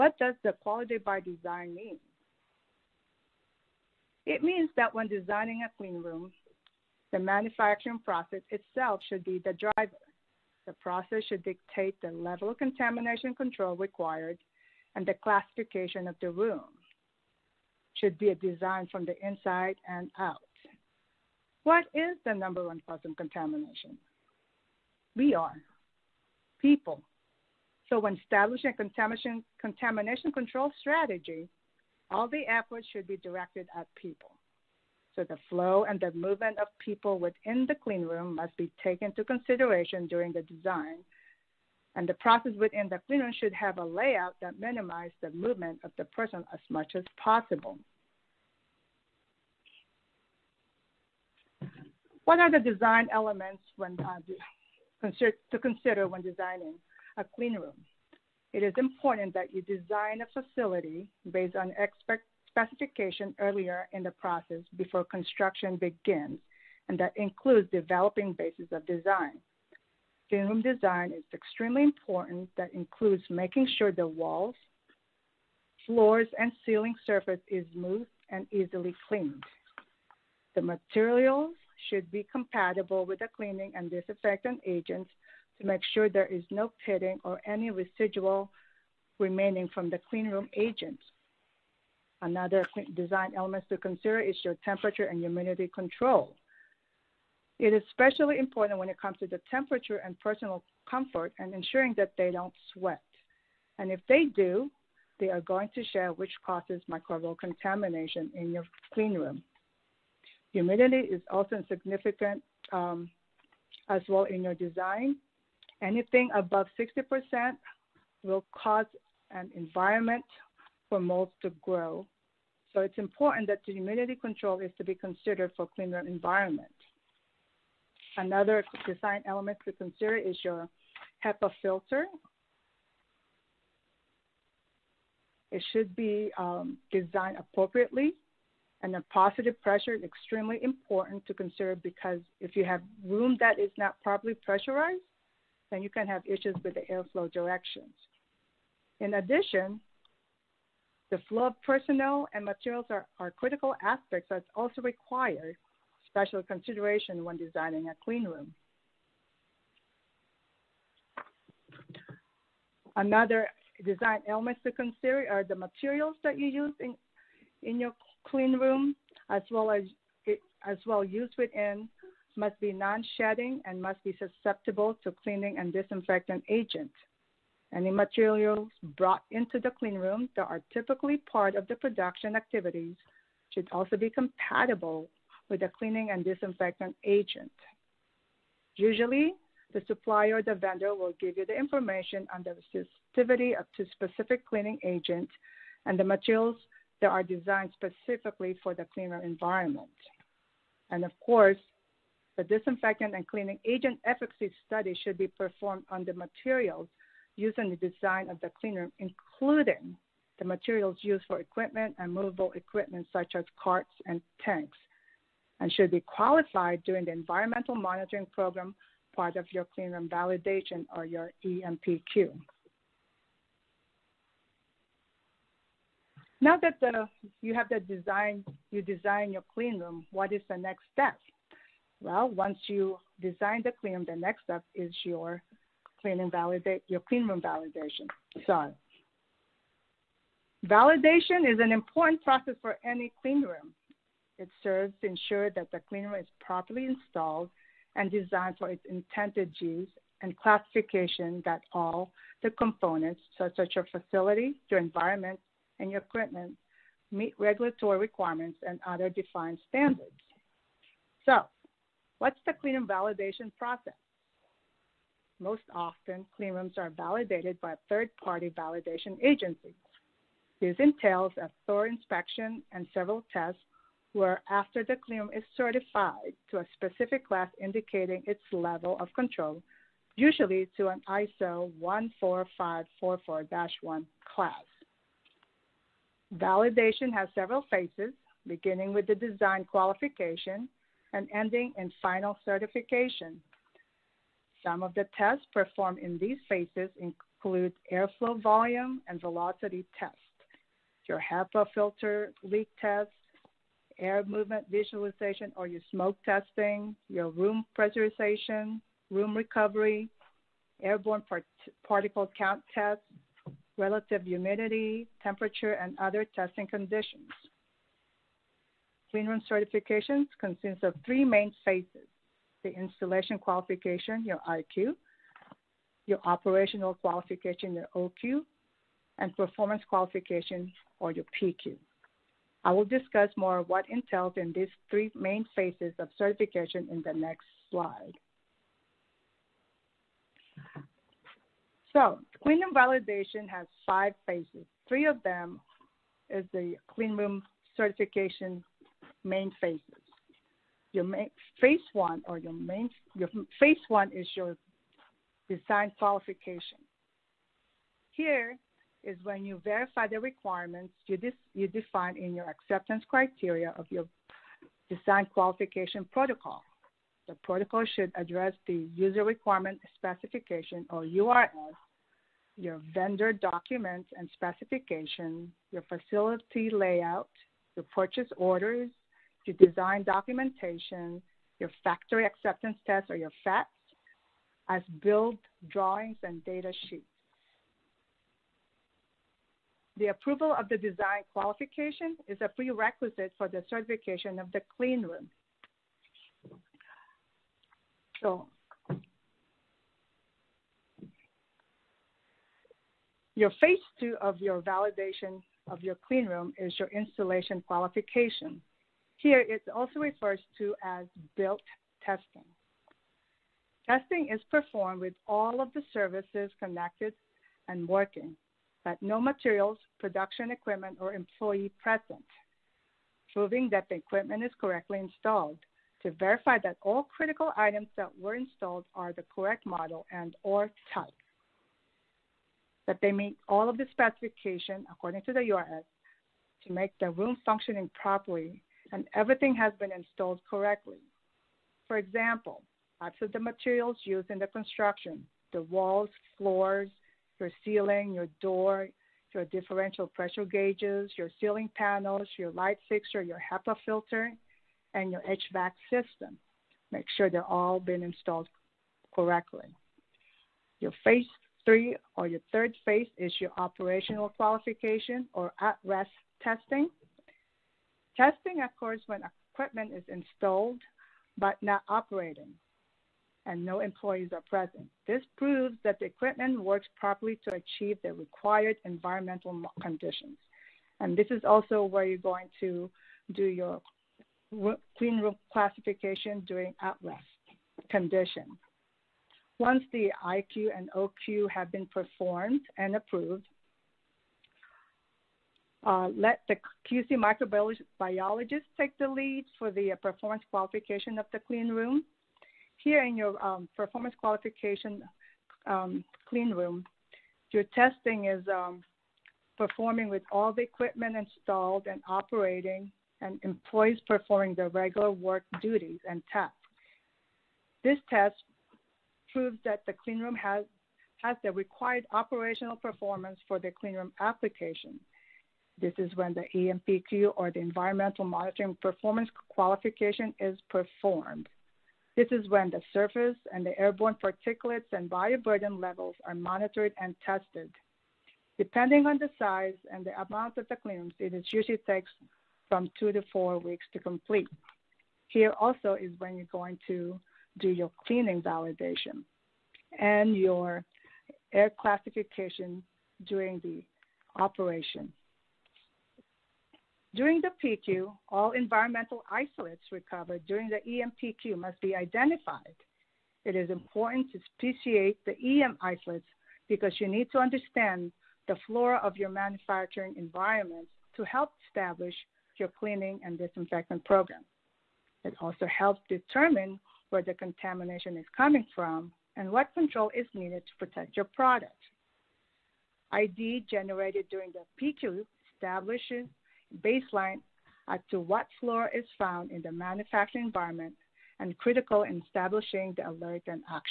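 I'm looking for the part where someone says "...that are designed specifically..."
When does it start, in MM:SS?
03:17.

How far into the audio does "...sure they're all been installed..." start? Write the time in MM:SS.
07:37.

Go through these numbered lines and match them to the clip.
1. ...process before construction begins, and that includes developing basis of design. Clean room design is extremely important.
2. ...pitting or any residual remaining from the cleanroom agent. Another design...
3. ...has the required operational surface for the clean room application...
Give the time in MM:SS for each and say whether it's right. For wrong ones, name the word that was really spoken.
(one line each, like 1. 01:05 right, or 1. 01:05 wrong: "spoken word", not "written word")
1. 01:04 right
2. 01:26 right
3. 08:41 wrong: "performance", not "surface".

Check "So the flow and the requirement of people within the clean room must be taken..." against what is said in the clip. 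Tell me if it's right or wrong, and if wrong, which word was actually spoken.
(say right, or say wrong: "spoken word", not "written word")
wrong: "movement", not "requirement".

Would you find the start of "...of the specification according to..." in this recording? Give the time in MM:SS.
07:13.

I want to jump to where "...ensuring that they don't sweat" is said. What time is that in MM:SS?
01:41.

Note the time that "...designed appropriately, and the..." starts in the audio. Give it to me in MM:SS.
02:16.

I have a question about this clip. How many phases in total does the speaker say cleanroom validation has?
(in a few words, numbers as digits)
5.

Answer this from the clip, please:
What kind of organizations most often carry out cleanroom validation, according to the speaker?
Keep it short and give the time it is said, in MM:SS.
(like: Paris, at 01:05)
Third party validation agencies, at 04:27.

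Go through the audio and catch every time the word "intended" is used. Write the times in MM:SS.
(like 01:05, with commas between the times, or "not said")
04:08.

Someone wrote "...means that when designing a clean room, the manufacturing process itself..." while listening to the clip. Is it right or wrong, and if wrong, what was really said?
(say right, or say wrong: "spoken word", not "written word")
right.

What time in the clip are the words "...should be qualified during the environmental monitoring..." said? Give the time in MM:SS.
03:35.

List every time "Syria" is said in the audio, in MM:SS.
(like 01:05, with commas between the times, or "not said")
not said.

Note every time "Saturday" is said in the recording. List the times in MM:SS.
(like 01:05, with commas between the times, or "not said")
not said.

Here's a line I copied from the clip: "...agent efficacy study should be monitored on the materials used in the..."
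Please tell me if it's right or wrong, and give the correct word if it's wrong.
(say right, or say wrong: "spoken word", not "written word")
wrong: "performed", not "monitored".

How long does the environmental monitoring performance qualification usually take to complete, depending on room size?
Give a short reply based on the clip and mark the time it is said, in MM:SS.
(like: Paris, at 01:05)
2 to 4 weeks, at 09:02.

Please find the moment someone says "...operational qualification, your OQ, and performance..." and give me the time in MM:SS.
05:26.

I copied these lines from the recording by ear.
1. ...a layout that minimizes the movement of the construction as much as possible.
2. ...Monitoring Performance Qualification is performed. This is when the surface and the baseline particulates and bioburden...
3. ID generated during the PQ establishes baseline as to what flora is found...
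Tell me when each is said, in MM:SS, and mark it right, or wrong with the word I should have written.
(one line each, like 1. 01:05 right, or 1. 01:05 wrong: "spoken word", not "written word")
1. 00:43 wrong: "person", not "construction"
2. 08:48 wrong: "airborne", not "baseline"
3. 09:43 right.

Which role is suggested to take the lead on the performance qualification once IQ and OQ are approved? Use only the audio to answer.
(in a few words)
QC microbiologist.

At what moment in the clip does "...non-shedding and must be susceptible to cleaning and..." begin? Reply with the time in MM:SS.
02:52.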